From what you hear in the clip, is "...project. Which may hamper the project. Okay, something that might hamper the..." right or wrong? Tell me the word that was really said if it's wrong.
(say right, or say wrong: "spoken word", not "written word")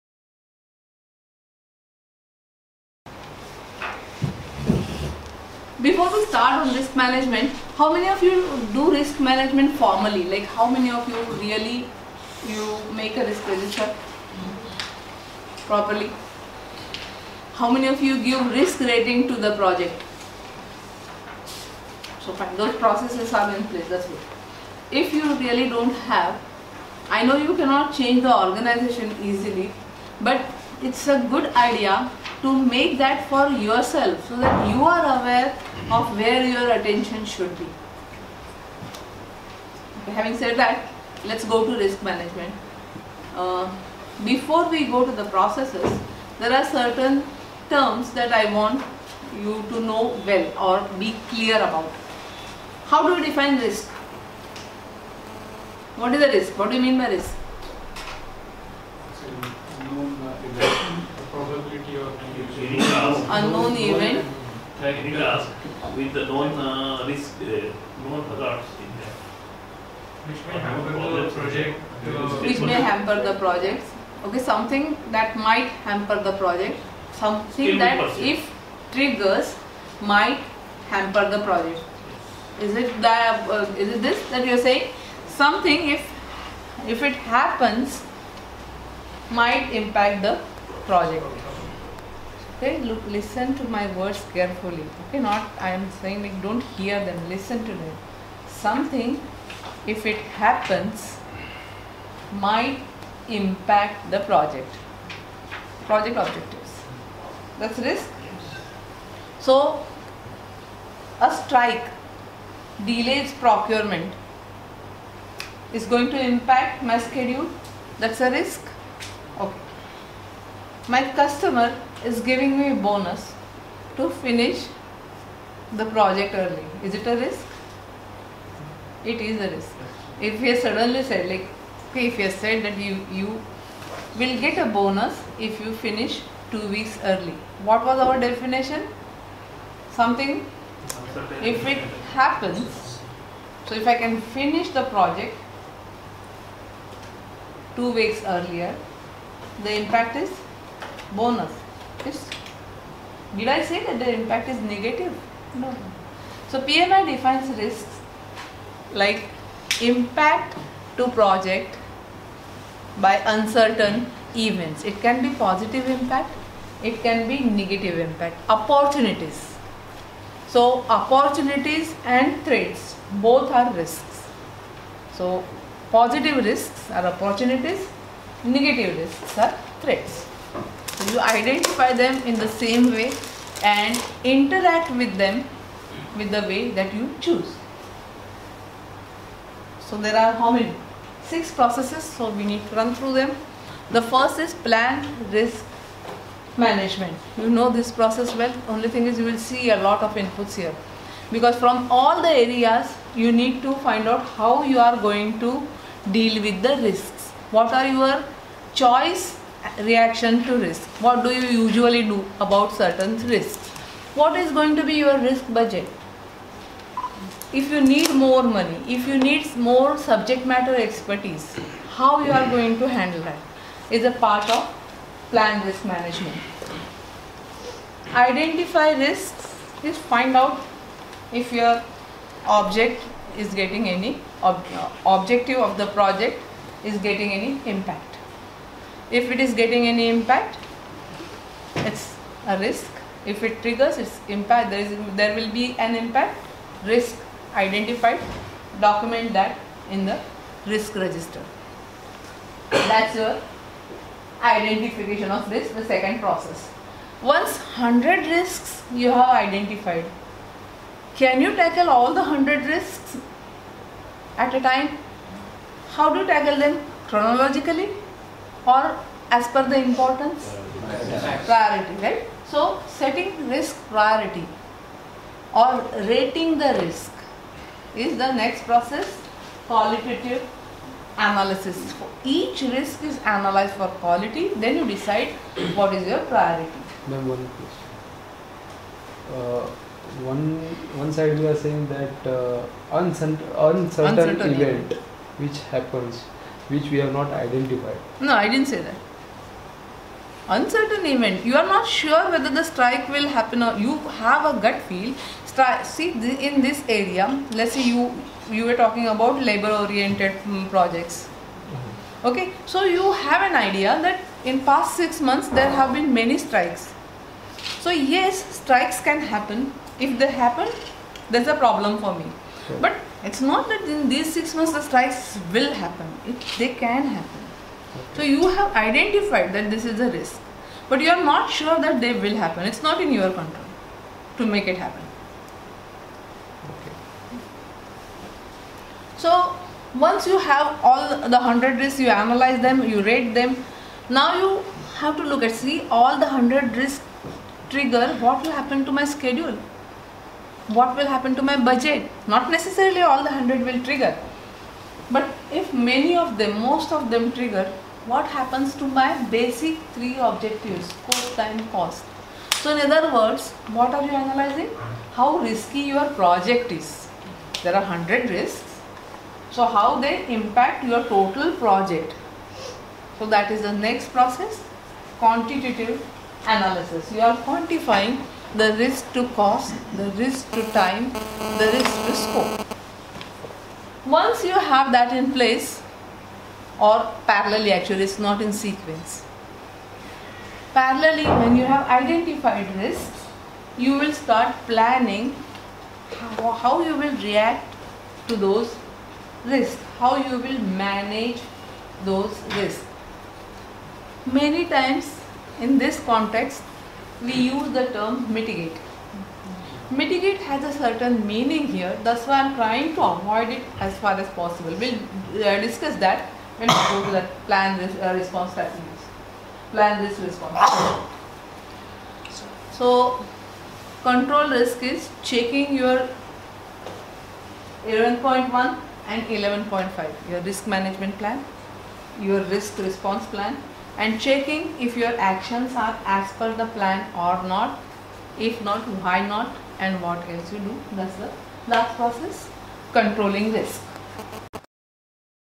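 right.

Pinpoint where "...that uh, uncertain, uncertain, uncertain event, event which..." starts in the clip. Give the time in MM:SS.
04:51.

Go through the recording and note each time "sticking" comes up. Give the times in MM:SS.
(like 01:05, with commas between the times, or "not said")
not said.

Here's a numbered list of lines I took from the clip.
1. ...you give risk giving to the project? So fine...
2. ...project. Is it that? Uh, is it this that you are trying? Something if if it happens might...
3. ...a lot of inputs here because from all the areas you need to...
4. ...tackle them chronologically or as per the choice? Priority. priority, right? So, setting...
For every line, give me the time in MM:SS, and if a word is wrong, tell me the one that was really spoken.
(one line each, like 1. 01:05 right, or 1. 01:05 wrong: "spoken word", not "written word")
1. 00:18 wrong: "rating", not "giving"
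2. 01:21 wrong: "saying", not "trying"
3. 03:19 right
4. 04:26 wrong: "importance", not "choice".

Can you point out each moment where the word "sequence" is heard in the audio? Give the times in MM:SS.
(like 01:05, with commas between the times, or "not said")
06:28.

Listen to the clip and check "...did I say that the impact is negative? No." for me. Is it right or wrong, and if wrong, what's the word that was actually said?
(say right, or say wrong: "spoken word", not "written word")
right.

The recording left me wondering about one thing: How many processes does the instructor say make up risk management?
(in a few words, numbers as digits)
6.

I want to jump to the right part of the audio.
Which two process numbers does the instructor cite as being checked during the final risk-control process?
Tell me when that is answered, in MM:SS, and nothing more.
07:07.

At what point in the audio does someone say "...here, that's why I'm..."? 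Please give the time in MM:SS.
06:51.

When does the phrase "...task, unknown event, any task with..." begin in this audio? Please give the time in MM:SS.
01:02.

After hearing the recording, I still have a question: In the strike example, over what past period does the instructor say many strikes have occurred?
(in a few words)
6 months.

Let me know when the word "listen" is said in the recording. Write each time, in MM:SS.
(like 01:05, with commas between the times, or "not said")
01:33, 01:37.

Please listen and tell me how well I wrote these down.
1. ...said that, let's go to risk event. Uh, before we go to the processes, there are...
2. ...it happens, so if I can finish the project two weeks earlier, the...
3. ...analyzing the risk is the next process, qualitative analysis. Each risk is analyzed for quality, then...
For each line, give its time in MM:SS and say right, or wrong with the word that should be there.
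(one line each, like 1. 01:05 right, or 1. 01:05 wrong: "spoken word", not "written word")
1. 00:40 wrong: "management", not "event"
2. 02:21 right
3. 04:36 wrong: "rating", not "analyzing".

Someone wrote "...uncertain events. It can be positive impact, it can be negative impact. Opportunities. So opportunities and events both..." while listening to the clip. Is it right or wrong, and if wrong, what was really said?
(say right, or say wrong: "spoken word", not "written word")
wrong: "threats", not "events".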